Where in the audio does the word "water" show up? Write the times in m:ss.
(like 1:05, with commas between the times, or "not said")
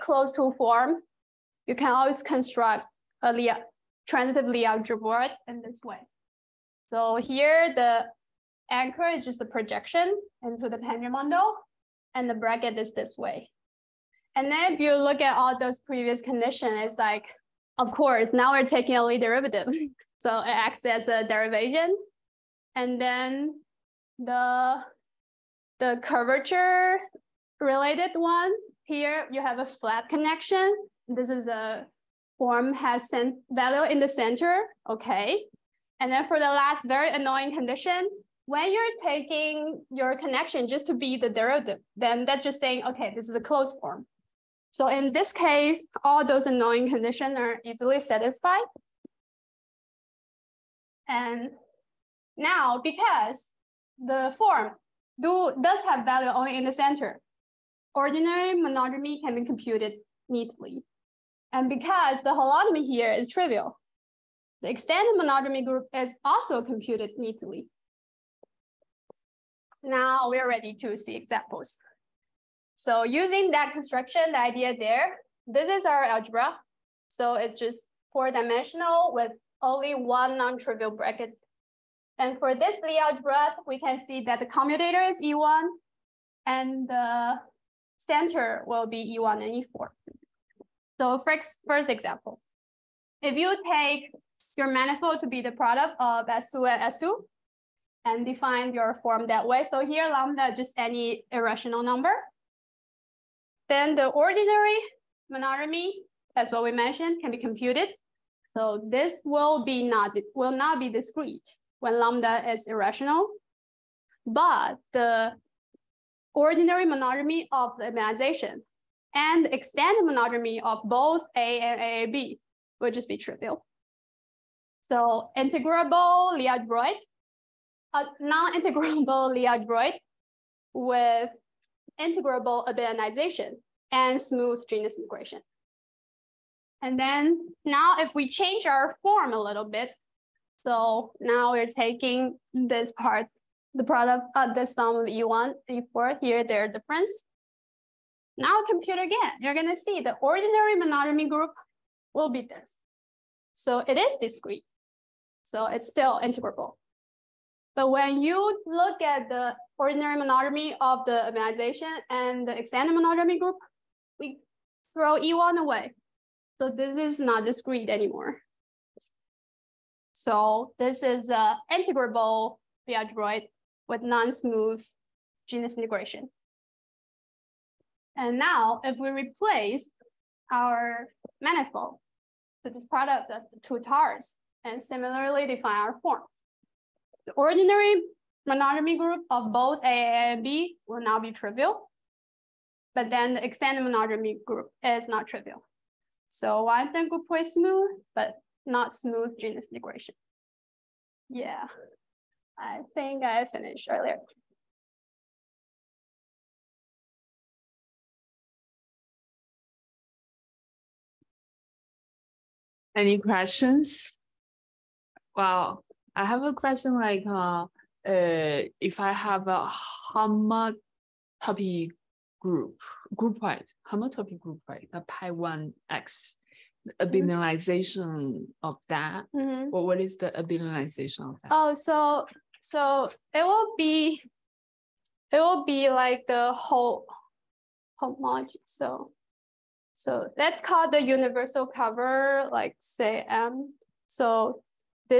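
not said.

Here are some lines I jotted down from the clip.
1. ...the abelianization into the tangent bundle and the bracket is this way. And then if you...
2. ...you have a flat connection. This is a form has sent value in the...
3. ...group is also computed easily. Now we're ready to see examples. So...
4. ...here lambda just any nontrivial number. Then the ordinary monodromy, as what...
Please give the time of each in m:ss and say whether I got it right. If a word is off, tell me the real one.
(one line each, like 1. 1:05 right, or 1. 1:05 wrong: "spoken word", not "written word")
1. 0:09 wrong: "projection", not "abelianization"
2. 0:29 right
3. 1:05 wrong: "neatly", not "easily"
4. 1:39 wrong: "irrational", not "nontrivial".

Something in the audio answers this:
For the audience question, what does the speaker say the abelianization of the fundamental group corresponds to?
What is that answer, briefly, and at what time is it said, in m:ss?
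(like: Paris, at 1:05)
The whole homology, at 3:56.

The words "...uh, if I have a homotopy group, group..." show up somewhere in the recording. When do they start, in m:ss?
3:37.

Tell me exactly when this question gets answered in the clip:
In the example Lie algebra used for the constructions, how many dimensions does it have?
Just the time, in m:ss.
1:18.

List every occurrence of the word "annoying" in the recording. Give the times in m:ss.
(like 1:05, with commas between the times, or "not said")
0:37, 0:46.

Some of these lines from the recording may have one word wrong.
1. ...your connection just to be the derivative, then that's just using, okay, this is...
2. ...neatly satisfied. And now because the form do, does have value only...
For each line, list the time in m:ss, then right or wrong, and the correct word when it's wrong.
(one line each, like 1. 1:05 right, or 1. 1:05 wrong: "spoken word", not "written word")
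1. 0:39 wrong: "saying", not "using"
2. 0:47 wrong: "easily", not "neatly".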